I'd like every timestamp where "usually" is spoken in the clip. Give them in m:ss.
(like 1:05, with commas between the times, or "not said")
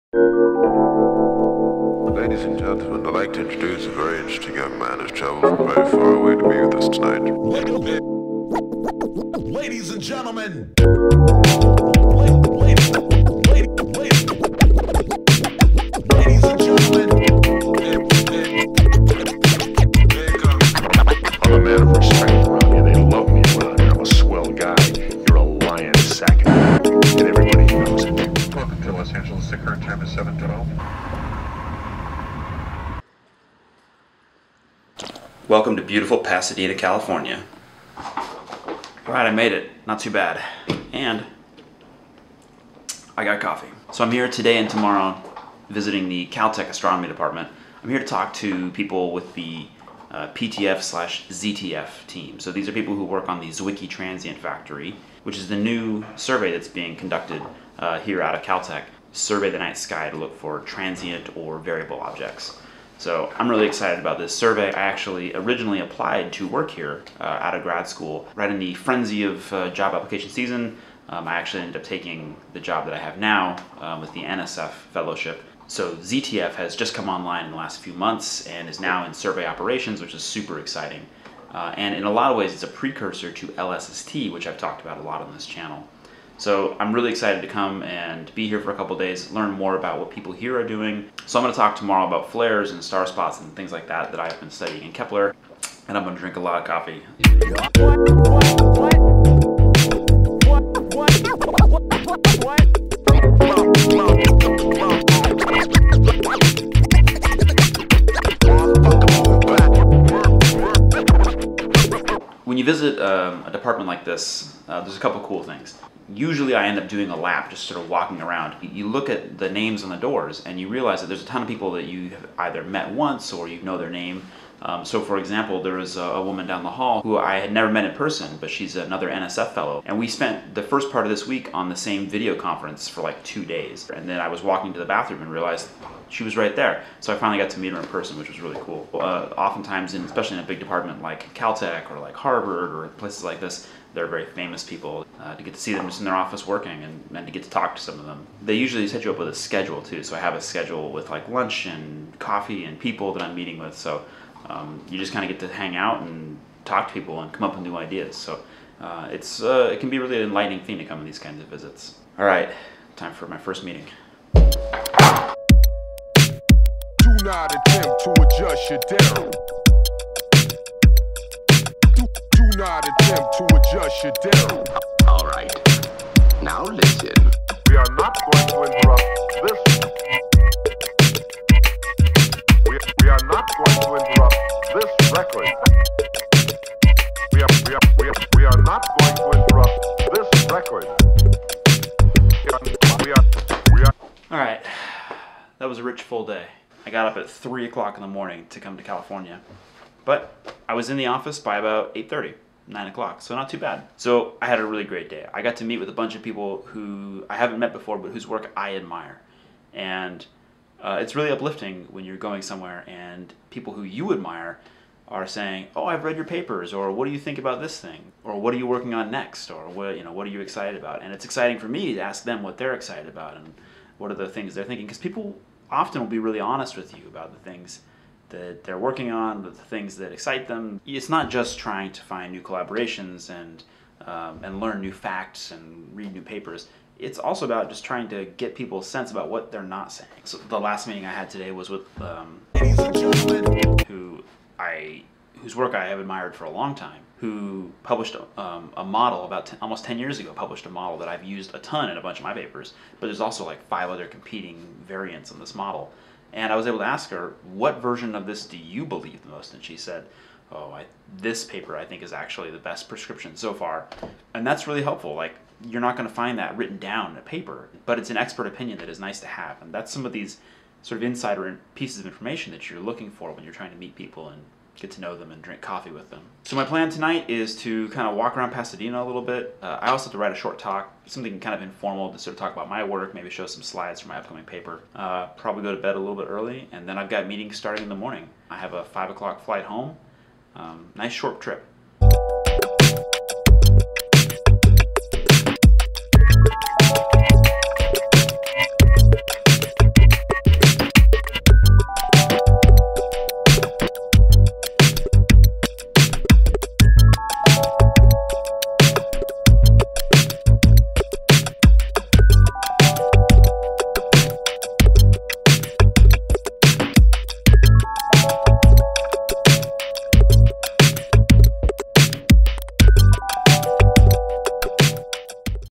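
1:56, 2:28.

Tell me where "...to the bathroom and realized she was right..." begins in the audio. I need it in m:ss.
2:14.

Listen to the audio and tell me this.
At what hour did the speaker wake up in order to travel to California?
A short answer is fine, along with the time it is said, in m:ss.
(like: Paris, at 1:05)
3 o'clock, at 3:17.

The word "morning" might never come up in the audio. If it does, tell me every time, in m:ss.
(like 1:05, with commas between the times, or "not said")
3:18, 4:47.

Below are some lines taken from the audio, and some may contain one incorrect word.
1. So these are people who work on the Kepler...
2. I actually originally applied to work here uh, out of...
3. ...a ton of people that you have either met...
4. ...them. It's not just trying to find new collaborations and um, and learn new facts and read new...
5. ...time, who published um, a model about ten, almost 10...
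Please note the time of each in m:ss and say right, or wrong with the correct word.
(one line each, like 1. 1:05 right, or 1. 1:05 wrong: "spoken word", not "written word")
1. 0:52 wrong: "Zwicky", not "Kepler"
2. 1:04 right
3. 2:01 right
4. 3:50 right
5. 4:06 right.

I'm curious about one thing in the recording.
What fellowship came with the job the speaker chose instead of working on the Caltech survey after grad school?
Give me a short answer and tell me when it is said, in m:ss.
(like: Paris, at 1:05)
NSF fellowship, at 1:14.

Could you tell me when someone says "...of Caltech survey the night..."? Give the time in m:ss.
0:58.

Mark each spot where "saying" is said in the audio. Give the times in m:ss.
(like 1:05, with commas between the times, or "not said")
3:35, 3:59.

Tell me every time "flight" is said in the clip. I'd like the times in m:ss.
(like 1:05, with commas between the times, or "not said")
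4:49.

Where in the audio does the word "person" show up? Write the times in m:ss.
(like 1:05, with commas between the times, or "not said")
2:07, 2:17.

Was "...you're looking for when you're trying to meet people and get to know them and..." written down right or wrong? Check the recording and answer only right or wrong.
right.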